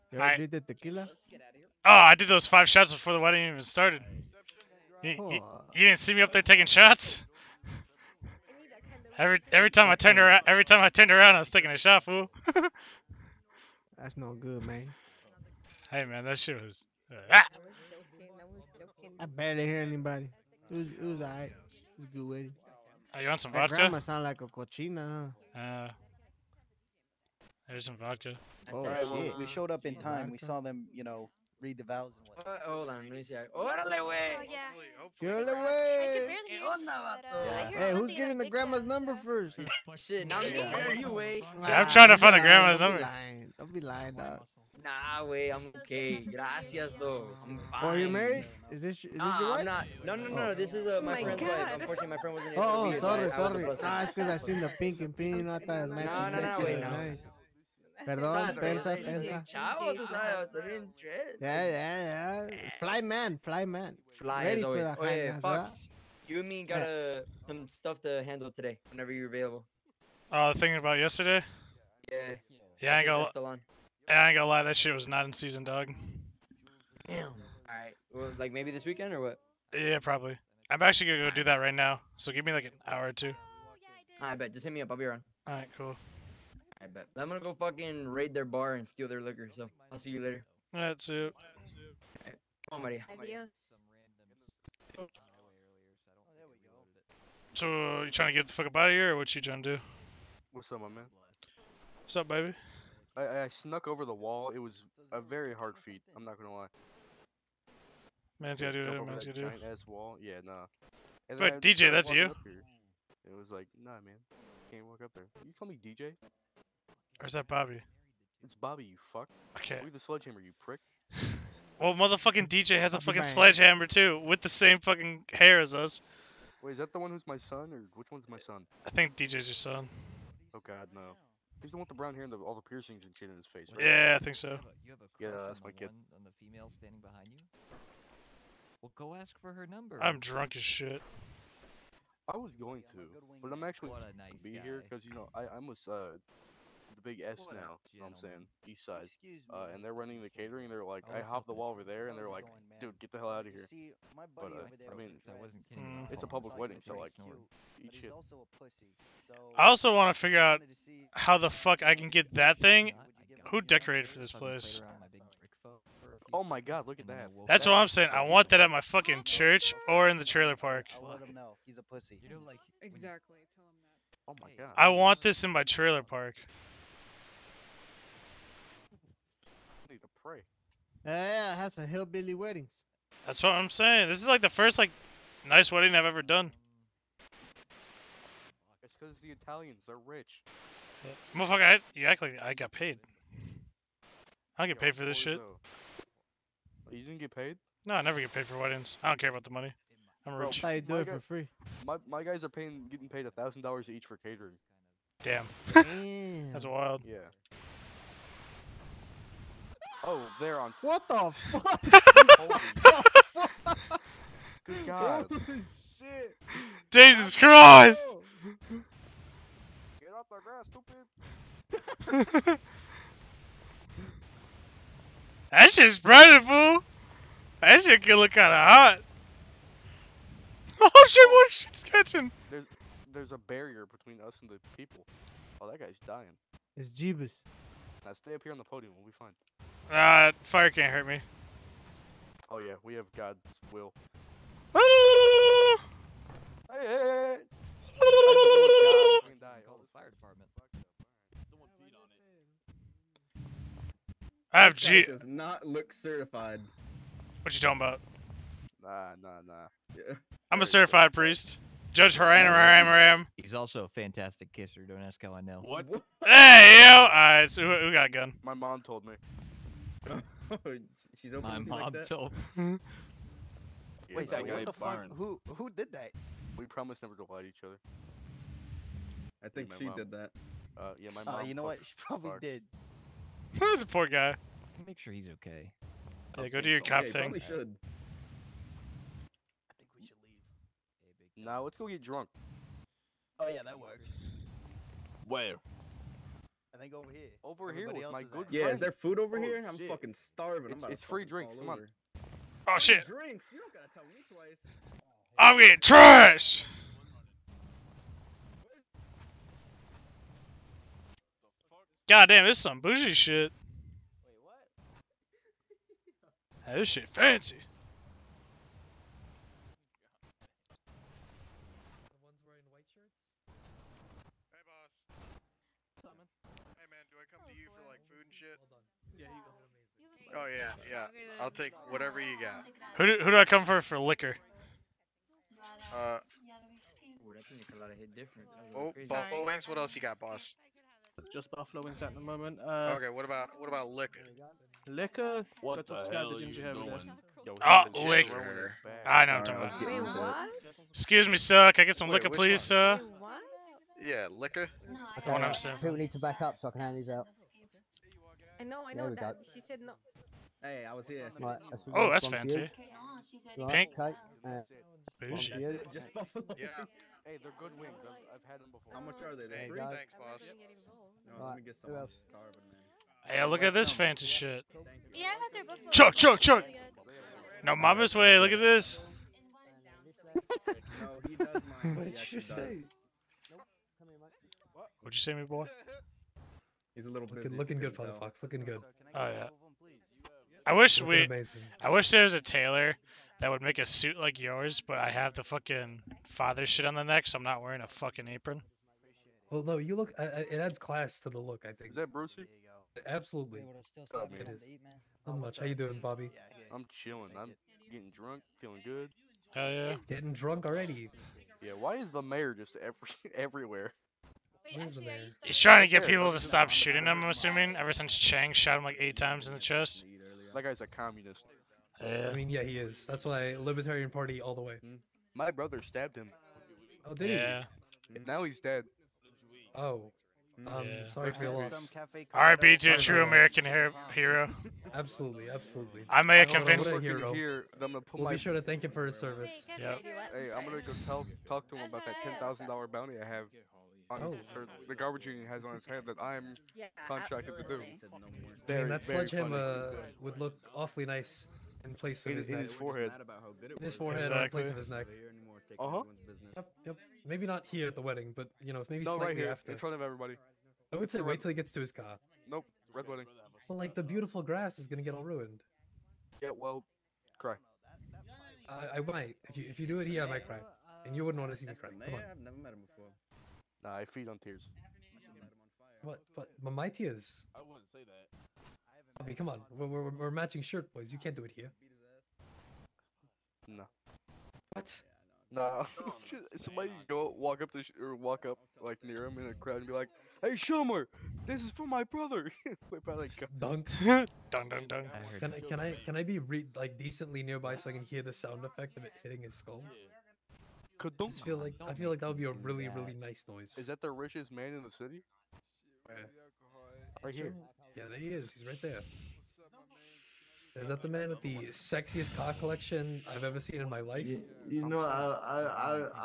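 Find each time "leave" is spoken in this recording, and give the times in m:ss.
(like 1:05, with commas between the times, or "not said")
1:59, 4:50.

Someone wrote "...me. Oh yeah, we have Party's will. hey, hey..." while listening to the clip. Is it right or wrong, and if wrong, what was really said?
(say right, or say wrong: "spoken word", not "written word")
wrong: "God", not "Party".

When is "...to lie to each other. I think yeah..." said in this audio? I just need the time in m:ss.
4:37.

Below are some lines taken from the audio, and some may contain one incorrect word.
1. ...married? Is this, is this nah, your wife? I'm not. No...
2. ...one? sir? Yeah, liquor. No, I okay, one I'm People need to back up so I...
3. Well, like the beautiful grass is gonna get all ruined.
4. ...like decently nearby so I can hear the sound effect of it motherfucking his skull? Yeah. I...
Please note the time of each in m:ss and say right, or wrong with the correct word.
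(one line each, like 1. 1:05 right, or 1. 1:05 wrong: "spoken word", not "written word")
1. 0:48 right
2. 5:52 right
3. 7:43 right
4. 8:16 wrong: "hitting", not "motherfucking".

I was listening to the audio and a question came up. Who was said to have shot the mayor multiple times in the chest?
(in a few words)
Chang.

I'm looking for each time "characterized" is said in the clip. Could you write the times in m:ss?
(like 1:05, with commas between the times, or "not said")
not said.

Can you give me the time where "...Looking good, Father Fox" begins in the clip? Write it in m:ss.
6:27.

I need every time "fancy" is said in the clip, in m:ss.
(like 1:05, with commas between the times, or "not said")
5:17, 6:02, 6:13.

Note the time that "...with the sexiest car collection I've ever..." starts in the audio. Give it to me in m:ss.
8:31.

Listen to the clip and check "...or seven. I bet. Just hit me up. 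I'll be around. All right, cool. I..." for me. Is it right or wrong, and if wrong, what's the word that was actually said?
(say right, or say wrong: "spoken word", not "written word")
wrong: "two", not "seven".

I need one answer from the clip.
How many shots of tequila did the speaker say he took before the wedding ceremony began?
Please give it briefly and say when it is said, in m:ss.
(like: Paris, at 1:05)
5, at 0:02.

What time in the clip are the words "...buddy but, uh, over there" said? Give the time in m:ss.
2:34.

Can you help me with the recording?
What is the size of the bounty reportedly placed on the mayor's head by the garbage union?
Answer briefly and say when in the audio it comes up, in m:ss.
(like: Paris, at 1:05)
$10,000, at 7:22.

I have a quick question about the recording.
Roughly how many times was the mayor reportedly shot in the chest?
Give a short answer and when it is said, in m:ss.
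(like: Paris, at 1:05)
8, at 6:58.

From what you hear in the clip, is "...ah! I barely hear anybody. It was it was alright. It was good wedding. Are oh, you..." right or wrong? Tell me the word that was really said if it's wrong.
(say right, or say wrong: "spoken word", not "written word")
right.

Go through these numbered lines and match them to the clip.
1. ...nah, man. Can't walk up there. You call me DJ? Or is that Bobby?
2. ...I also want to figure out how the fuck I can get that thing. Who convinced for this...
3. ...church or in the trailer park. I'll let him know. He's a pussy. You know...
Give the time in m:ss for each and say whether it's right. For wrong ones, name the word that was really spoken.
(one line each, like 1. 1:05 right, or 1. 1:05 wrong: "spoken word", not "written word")
1. 1:53 right
2. 2:39 wrong: "decorated", not "convinced"
3. 2:49 right.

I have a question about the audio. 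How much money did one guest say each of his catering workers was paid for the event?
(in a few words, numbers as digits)
$1,000.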